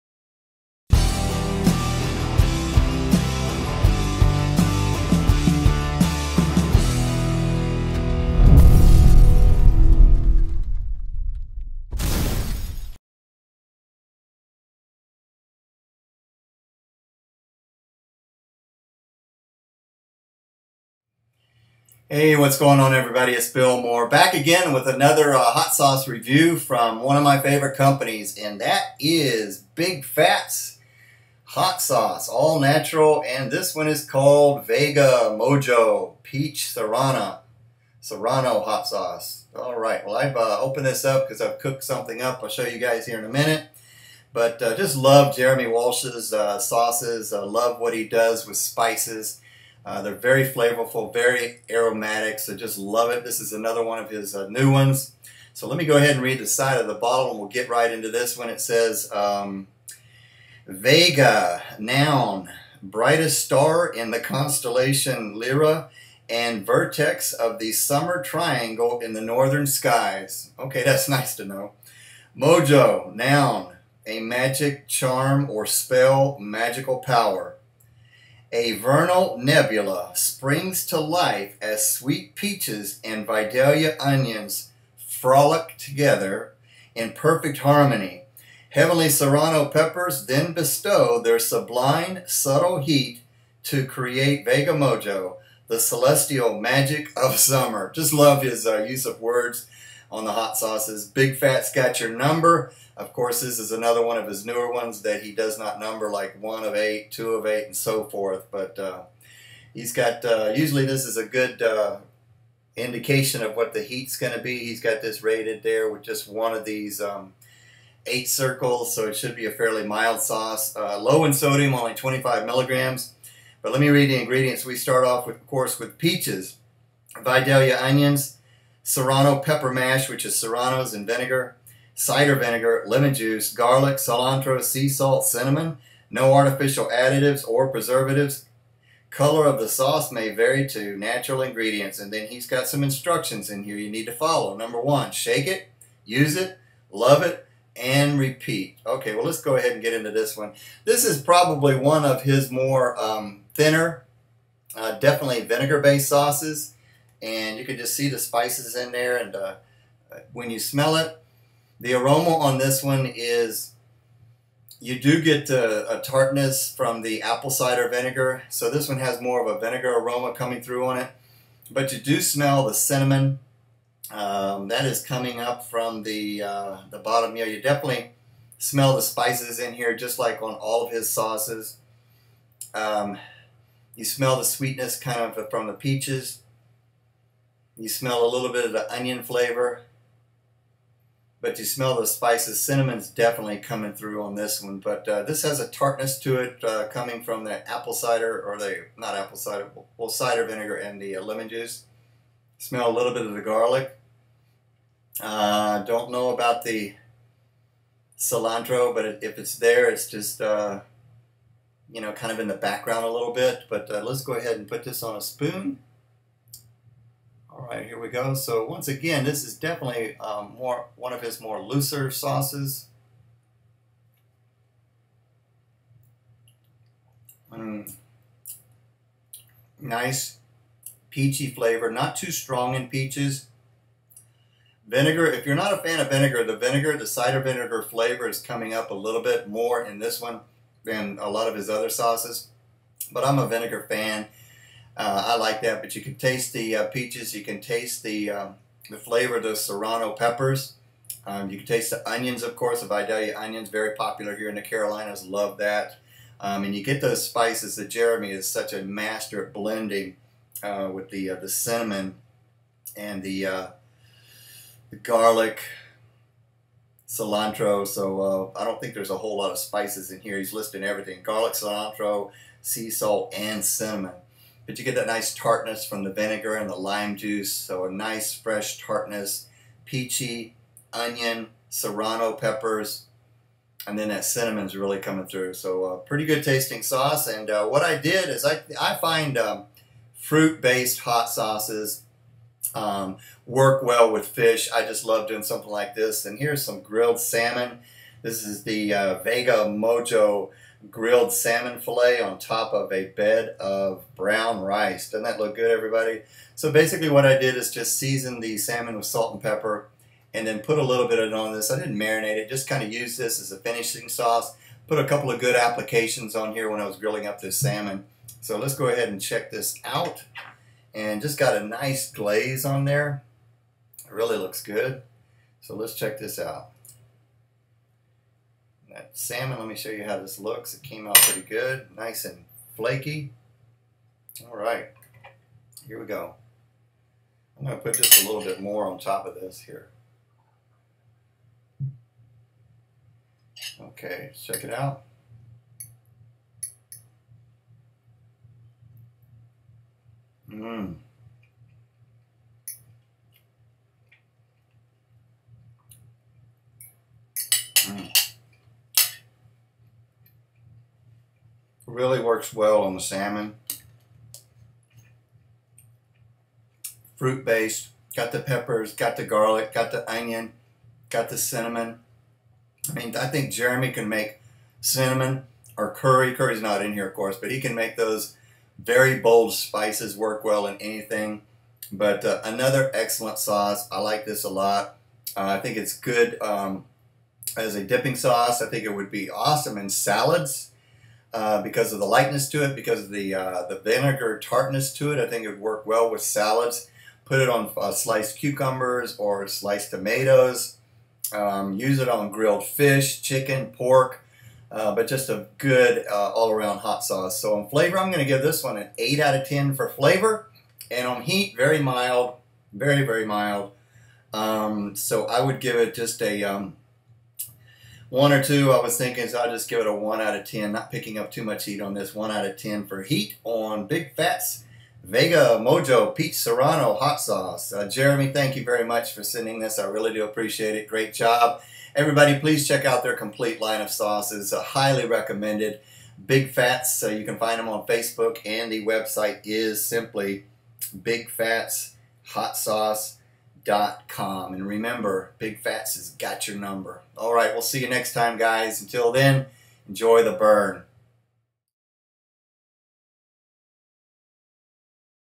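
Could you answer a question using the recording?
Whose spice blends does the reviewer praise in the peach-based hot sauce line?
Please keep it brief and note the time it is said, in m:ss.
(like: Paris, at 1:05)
Jeremy Walsh, at 0:45.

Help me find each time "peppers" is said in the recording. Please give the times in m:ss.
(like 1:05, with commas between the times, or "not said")
1:29, 2:09, 4:10, 4:42, 5:09, 6:08.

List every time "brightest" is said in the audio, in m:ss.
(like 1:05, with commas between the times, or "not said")
1:02.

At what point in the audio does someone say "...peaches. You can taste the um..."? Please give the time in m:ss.
4:06.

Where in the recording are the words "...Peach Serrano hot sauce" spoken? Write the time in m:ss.
7:06.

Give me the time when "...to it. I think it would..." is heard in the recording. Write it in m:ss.
6:34.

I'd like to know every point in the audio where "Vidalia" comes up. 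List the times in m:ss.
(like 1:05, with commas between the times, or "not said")
1:23, 2:07, 4:12.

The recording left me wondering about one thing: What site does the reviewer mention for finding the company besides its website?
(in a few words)
Facebook.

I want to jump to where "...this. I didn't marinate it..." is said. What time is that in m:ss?
5:11.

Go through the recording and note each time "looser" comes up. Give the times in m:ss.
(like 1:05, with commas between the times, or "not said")
3:41.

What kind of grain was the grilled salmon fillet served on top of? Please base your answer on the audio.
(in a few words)
brown rice.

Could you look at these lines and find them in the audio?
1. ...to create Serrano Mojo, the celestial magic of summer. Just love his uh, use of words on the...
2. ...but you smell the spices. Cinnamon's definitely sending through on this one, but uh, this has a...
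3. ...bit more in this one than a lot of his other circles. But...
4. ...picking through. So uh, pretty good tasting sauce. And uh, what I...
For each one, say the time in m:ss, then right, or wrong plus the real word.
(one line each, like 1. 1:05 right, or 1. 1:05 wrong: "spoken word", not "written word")
1. 1:33 wrong: "Vega", not "Serrano"
2. 3:11 wrong: "coming", not "sending"
3. 3:59 wrong: "sauces", not "circles"
4. 4:44 wrong: "coming", not "picking".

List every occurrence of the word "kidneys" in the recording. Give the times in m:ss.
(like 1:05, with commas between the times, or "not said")
not said.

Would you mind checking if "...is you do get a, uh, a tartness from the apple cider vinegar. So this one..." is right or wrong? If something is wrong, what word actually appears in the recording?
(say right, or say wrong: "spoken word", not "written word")
right.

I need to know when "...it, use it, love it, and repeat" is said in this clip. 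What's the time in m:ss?
2:25.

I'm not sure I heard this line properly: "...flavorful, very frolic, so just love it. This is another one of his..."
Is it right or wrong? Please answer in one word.
wrong.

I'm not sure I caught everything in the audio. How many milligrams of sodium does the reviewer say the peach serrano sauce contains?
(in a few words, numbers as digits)
25.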